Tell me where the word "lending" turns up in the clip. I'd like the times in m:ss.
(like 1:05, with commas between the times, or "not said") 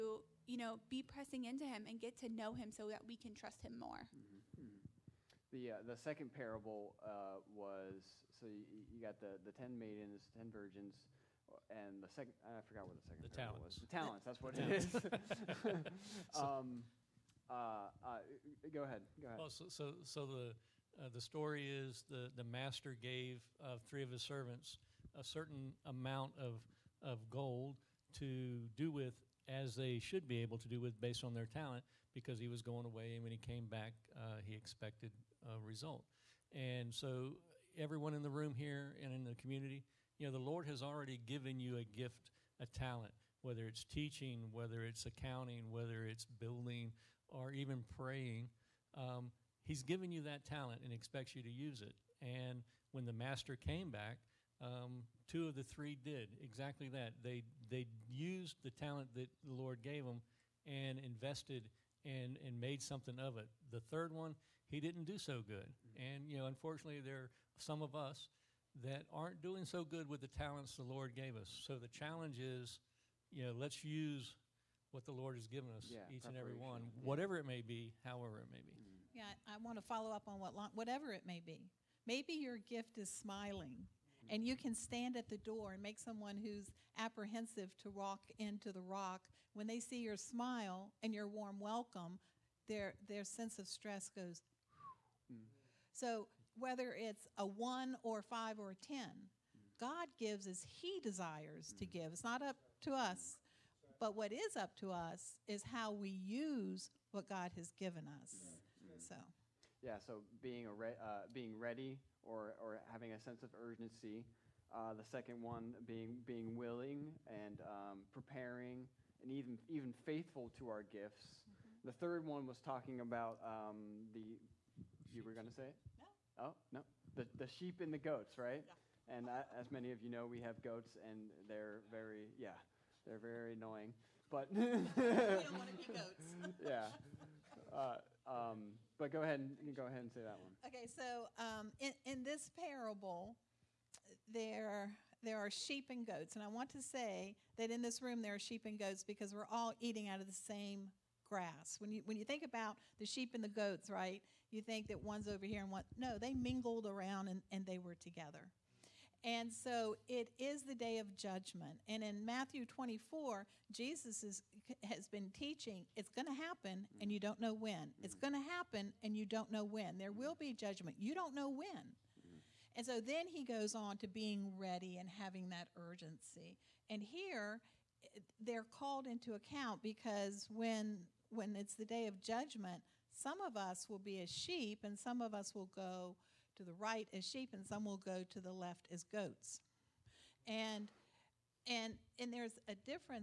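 not said.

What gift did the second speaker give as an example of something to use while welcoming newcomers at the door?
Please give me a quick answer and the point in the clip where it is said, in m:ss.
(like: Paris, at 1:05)
Smiling, at 1:23.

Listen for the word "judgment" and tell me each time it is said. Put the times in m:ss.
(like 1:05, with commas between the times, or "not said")
2:41, 2:50, 3:02.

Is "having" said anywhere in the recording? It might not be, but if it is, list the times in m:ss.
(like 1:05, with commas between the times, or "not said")
1:52, 2:55.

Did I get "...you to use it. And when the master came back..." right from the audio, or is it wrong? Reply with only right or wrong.
right.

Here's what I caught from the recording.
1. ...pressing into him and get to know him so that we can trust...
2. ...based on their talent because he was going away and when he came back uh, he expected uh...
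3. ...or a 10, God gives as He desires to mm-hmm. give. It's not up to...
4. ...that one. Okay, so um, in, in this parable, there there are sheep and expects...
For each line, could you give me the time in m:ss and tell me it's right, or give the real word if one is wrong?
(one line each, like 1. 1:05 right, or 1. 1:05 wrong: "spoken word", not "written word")
1. 0:01 right
2. 0:30 right
3. 1:38 right
4. 2:20 wrong: "goats", not "expects".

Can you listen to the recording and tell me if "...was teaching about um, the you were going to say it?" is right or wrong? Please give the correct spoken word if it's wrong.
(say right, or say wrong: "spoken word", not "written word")
wrong: "talking", not "teaching".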